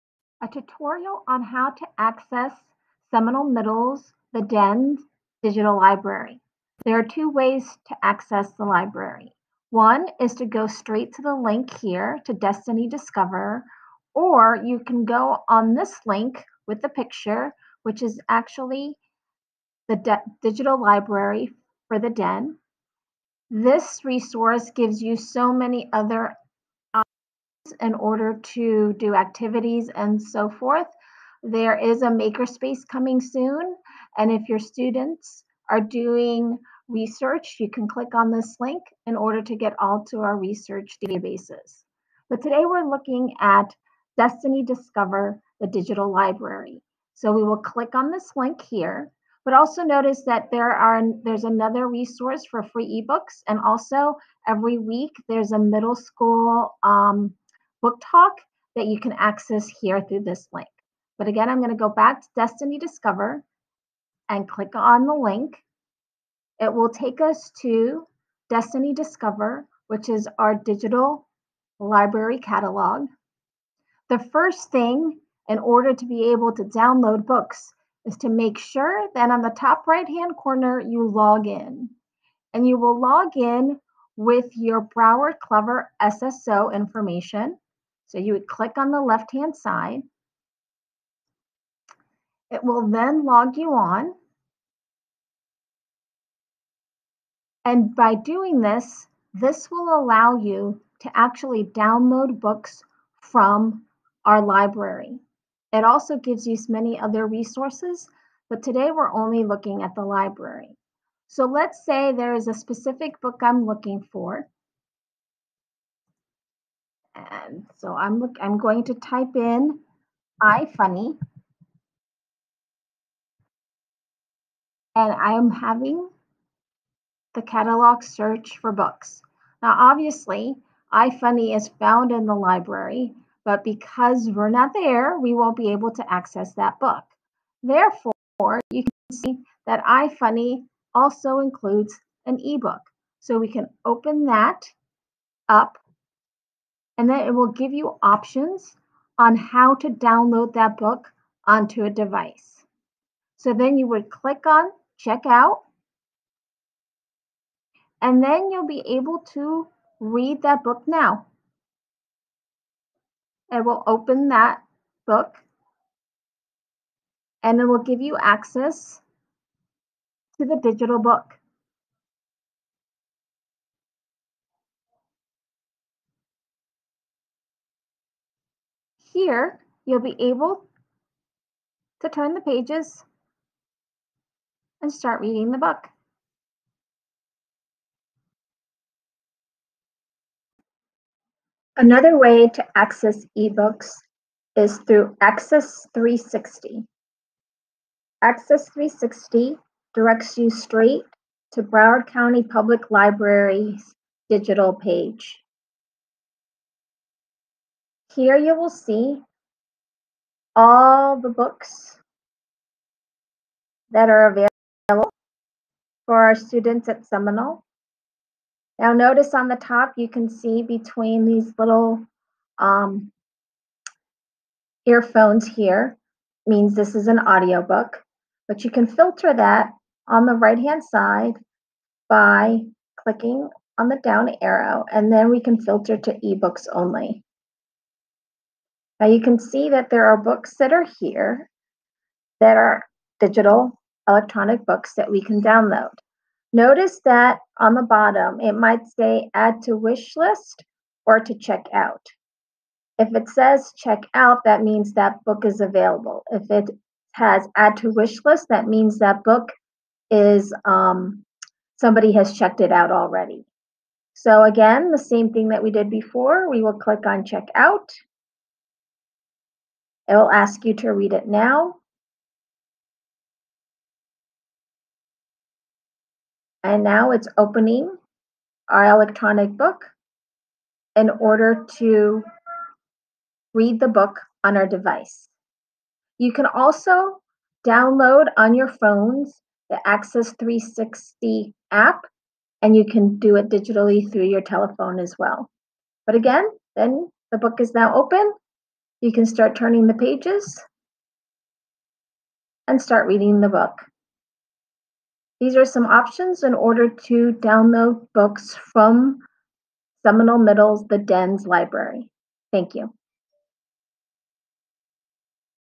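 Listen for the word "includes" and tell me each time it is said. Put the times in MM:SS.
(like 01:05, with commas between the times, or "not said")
02:21.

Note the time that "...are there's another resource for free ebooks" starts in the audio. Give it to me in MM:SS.
00:50.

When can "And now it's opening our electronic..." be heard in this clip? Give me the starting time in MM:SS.
04:36.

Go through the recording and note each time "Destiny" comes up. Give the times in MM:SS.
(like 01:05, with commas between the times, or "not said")
00:12, 00:44, 01:02, 01:08.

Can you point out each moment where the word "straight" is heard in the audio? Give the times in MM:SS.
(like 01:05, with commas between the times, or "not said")
00:10, 03:20.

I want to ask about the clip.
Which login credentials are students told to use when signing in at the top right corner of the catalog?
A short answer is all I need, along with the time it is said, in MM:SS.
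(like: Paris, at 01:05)
Broward Clever SSO, at 01:24.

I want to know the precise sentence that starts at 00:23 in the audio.
This resource gives you so many other in order to do activities and so forth.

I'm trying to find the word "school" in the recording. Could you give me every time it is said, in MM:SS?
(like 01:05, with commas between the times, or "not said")
00:55.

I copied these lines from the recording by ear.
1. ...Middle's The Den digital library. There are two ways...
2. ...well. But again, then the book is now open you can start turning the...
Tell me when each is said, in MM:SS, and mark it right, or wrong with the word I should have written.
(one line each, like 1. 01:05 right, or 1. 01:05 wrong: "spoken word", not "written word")
1. 00:03 right
2. 04:55 right.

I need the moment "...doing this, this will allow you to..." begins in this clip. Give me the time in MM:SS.
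01:38.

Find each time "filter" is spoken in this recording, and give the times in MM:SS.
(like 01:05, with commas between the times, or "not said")
03:48, 03:55.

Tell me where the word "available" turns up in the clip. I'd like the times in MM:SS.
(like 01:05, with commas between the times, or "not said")
03:34, 04:15.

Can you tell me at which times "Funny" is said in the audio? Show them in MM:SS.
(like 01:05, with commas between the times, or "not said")
02:00, 02:11, 02:20.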